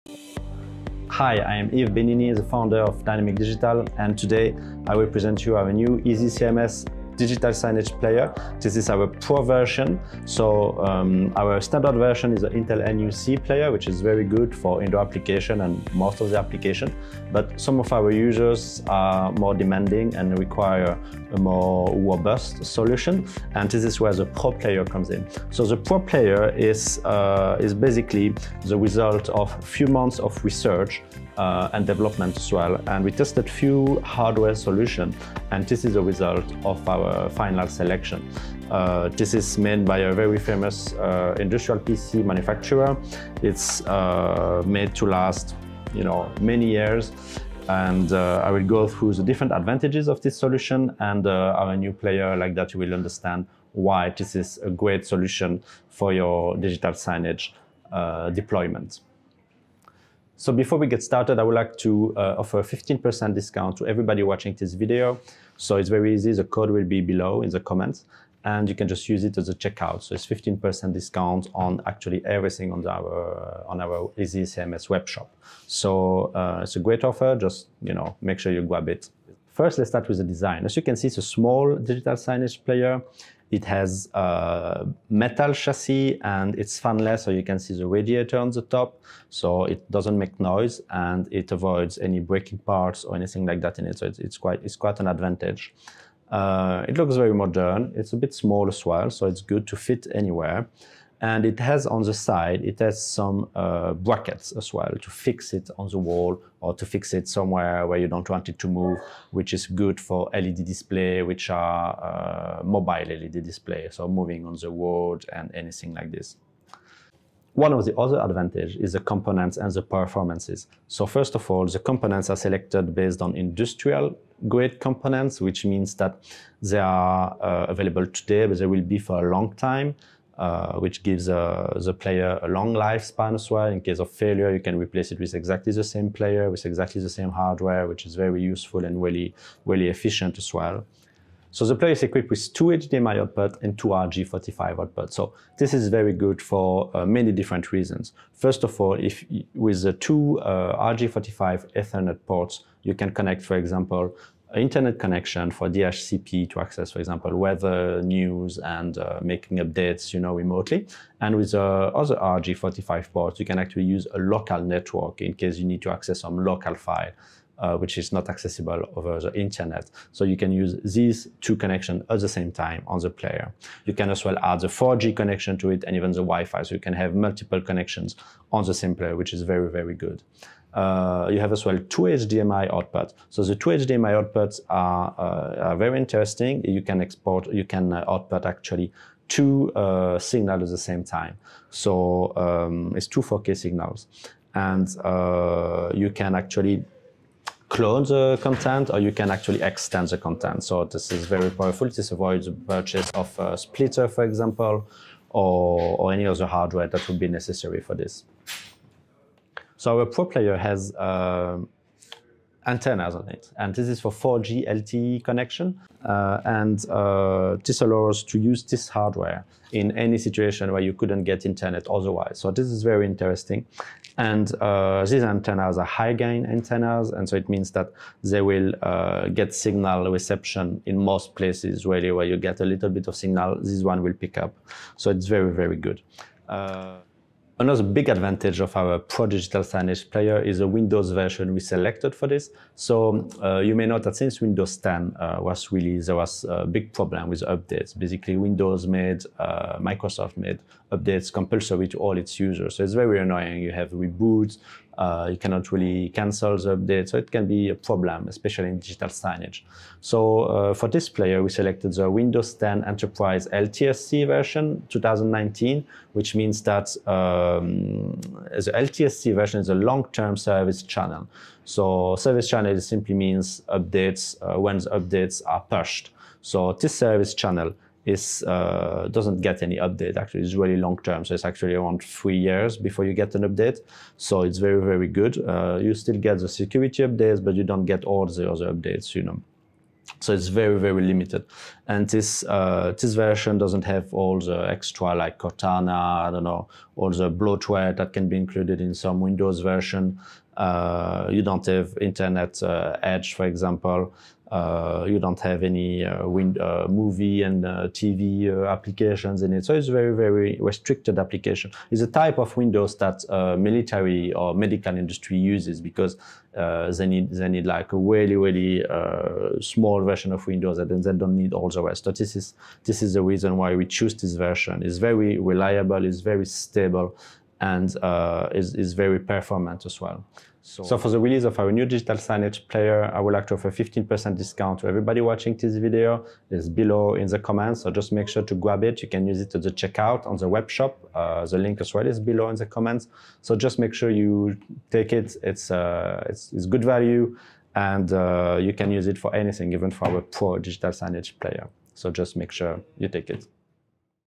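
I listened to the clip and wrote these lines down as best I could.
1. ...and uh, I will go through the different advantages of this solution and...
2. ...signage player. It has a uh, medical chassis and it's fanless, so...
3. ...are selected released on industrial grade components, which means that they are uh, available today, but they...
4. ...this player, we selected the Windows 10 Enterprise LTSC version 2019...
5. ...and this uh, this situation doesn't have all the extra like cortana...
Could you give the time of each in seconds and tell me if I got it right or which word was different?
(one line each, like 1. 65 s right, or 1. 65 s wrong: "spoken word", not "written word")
1. 47 s right
2. 82 s wrong: "metal", not "medical"
3. 122 s wrong: "based", not "released"
4. 260 s right
5. 291 s wrong: "version", not "situation".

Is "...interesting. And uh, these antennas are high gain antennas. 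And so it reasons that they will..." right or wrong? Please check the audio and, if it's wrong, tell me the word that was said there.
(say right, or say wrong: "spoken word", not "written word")
wrong: "means", not "reasons".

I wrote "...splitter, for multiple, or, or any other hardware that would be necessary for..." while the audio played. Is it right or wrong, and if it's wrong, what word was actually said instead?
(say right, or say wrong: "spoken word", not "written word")
wrong: "example", not "multiple".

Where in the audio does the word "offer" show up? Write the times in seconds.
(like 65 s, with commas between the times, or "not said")
62 s, 77 s, 333 s.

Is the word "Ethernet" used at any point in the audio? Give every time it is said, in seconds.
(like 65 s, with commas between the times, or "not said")
151 s.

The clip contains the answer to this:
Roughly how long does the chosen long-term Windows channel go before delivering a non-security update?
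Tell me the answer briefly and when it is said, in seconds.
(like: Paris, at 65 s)
around 3 years, at 281 s.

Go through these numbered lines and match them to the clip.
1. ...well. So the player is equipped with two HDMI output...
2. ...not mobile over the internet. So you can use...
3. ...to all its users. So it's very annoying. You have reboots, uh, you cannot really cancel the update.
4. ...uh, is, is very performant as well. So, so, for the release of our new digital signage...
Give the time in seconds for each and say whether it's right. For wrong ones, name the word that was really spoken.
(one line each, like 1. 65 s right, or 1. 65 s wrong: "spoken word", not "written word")
1. 140 s right
2. 168 s wrong: "accessible", not "mobile"
3. 251 s right
4. 328 s right.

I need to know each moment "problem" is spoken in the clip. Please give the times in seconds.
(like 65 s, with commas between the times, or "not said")
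246 s, 257 s.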